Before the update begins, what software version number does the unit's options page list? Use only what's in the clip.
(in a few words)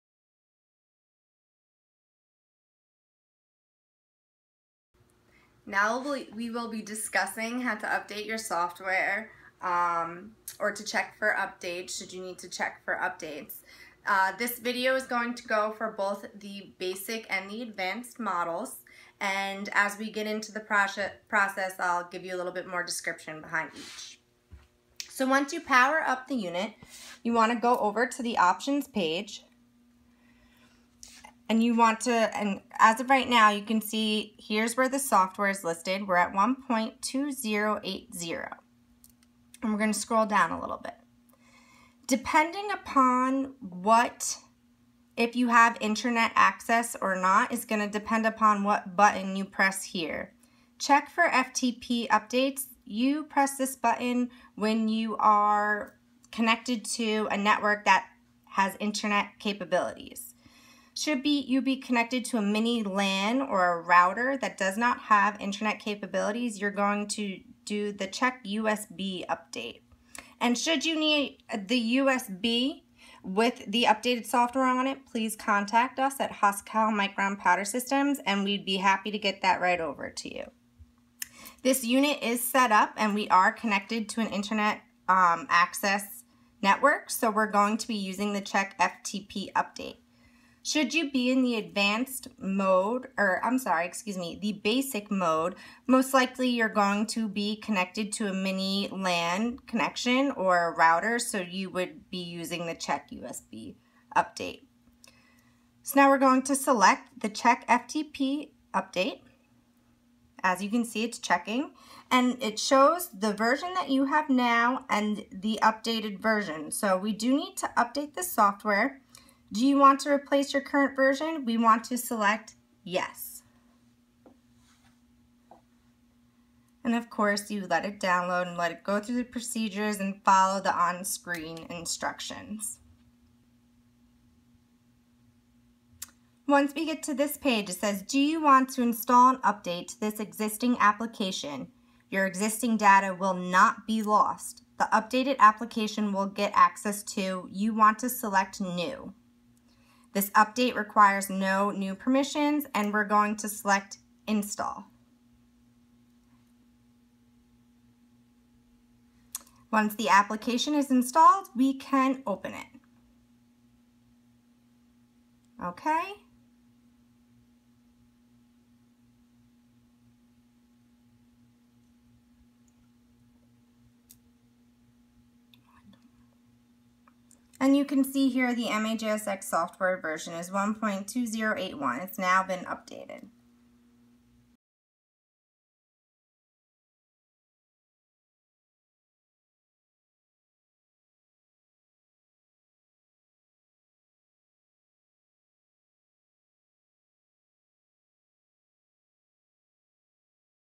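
1.2080.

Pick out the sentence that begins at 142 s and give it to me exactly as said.
Your existing data will not be lost.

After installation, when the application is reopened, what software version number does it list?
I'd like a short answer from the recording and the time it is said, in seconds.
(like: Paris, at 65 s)
1.2081, at 180 s.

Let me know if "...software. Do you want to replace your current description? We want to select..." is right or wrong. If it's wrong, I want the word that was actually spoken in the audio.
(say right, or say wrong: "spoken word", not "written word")
wrong: "version", not "description".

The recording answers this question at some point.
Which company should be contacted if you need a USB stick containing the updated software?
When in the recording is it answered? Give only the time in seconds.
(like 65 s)
76 s.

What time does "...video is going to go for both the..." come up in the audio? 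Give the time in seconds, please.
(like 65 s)
14 s.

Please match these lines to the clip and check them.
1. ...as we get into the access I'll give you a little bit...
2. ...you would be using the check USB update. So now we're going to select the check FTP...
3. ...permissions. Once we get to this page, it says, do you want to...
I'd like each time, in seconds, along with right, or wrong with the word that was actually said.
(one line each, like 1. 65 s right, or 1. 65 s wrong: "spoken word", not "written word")
1. 19 s wrong: "process", not "access"
2. 101 s right
3. 131 s wrong: "instructions", not "permissions".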